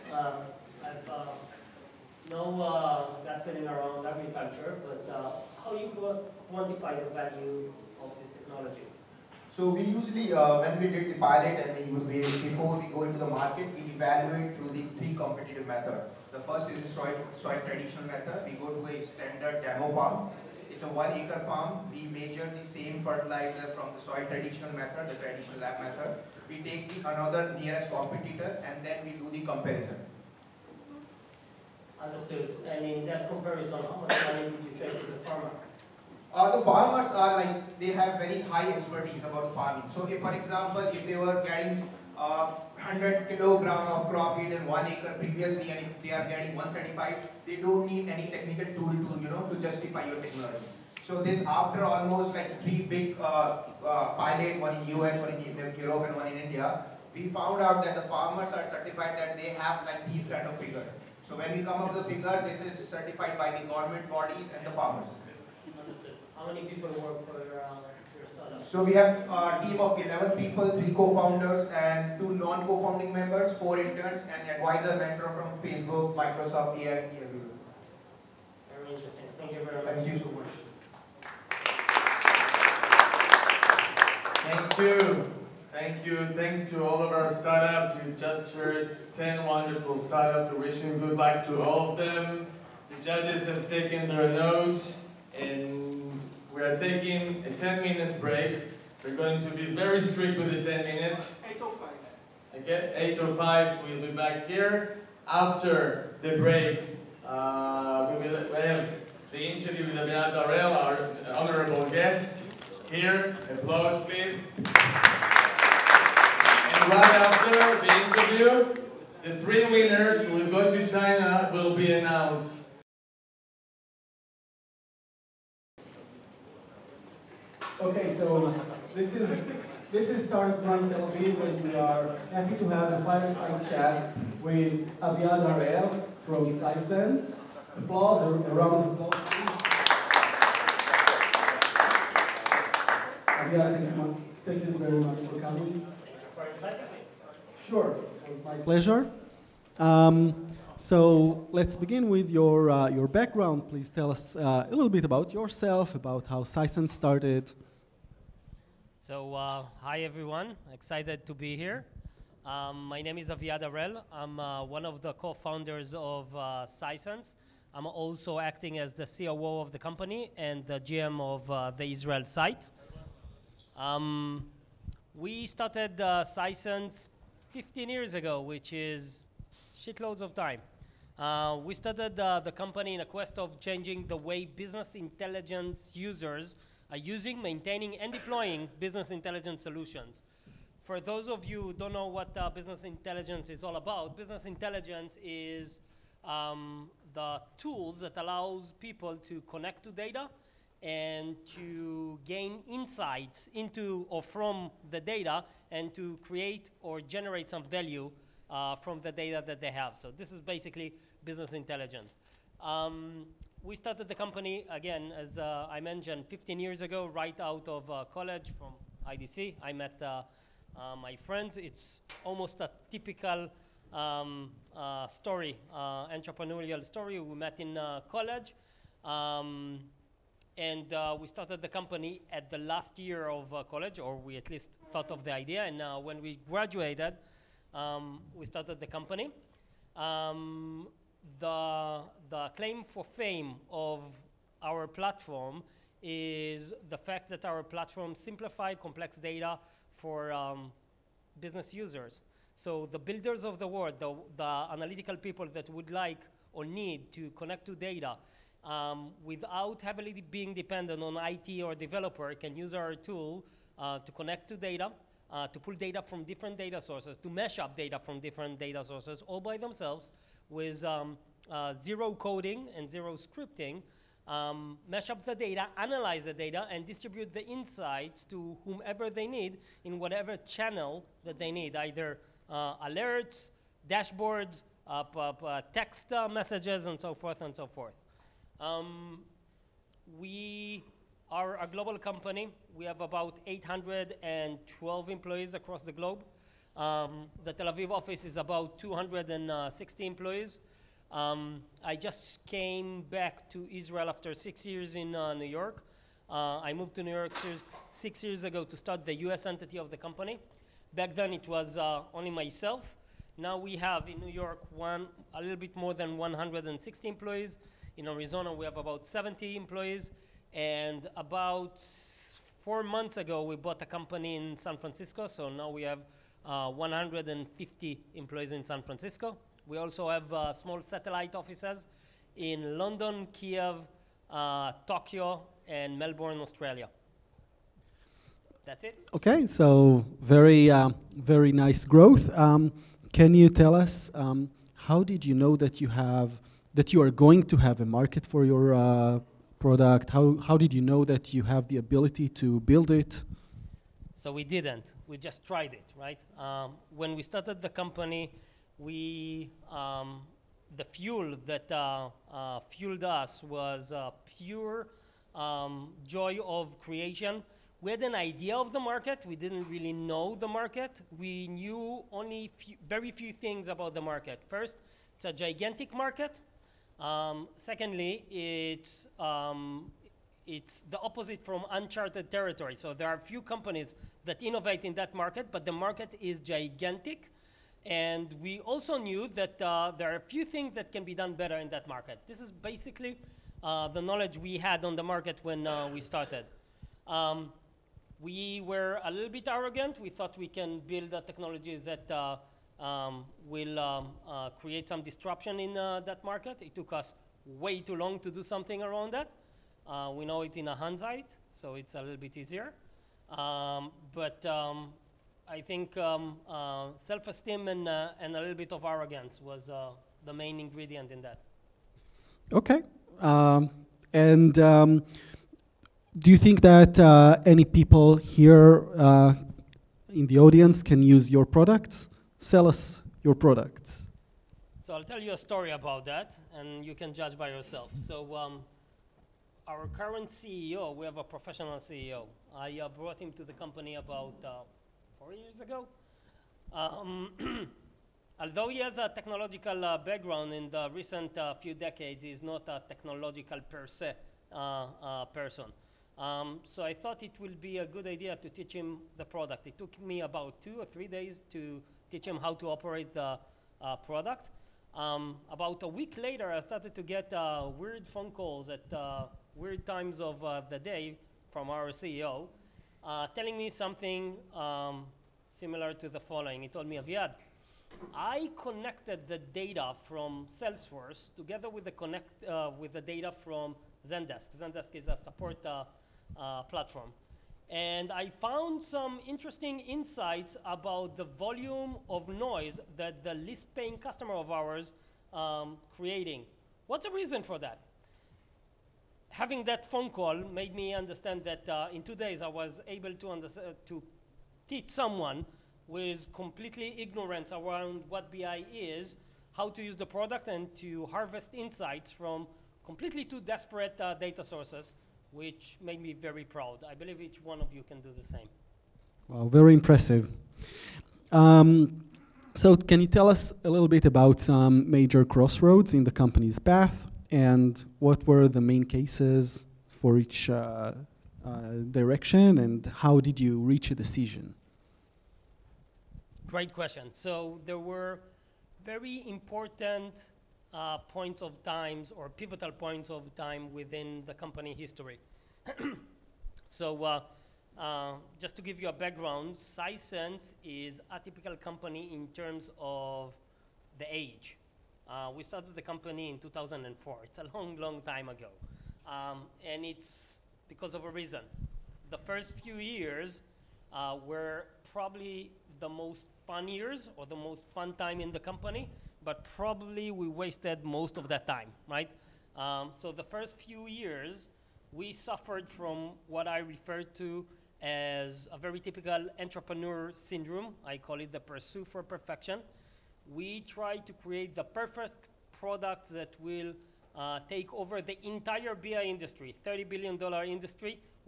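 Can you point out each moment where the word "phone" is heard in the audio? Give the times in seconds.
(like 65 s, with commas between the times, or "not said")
468 s, 499 s.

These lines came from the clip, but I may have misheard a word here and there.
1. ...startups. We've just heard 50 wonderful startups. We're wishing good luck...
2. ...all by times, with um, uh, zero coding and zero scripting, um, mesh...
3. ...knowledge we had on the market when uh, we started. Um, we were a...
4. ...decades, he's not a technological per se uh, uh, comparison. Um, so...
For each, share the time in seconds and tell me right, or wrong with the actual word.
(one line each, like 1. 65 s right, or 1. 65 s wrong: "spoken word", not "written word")
1. 87 s wrong: "10", not "50"
2. 269 s wrong: "themselves", not "times"
3. 394 s right
4. 451 s wrong: "person", not "comparison".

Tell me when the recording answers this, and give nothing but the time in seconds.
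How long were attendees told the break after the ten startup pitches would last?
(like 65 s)
97 s.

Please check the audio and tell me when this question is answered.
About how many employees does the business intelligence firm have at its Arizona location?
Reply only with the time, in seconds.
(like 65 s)
319 s.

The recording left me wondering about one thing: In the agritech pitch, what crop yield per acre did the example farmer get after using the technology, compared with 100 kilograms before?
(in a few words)
135.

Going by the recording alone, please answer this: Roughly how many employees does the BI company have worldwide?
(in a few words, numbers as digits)
812.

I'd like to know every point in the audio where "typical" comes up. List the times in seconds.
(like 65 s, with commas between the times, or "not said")
222 s, 551 s, 578 s.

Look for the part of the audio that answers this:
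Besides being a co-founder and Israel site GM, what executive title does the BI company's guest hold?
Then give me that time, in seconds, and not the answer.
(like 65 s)
169 s.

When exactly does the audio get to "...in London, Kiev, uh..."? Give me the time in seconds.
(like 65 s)
332 s.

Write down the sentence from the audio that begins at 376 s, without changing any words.
Um, secondly, it's, um, it's the opposite from uncharted territory.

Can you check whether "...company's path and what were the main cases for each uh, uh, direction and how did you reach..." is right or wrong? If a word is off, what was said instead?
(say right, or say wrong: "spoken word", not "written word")
right.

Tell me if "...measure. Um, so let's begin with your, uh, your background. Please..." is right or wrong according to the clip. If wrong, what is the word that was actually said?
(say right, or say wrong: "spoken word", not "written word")
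wrong: "pleasure", not "measure".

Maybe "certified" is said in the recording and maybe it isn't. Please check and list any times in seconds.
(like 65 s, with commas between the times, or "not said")
58 s, 62 s.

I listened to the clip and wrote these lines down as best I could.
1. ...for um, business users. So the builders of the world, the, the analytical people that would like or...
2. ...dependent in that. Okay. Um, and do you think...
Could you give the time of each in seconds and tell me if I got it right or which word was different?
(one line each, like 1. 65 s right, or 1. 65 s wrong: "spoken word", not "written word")
1. 249 s right
2. 420 s wrong: "ingredient", not "dependent".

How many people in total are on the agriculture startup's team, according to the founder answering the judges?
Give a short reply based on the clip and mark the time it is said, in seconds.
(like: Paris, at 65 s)
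11, at 69 s.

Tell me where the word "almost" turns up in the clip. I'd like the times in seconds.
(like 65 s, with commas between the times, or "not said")
51 s, 222 s.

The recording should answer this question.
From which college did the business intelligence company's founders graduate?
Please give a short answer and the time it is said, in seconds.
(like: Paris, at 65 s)
IDC, at 219 s.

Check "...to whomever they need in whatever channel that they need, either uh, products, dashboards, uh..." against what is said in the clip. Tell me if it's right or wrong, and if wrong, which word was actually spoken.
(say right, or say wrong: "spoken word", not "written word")
wrong: "alerts", not "products".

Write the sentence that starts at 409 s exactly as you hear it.
Uh, we know it in a hindsight, so it's a little bit easier.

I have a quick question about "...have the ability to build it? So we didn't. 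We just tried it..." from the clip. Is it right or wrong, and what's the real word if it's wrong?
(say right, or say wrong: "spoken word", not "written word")
right.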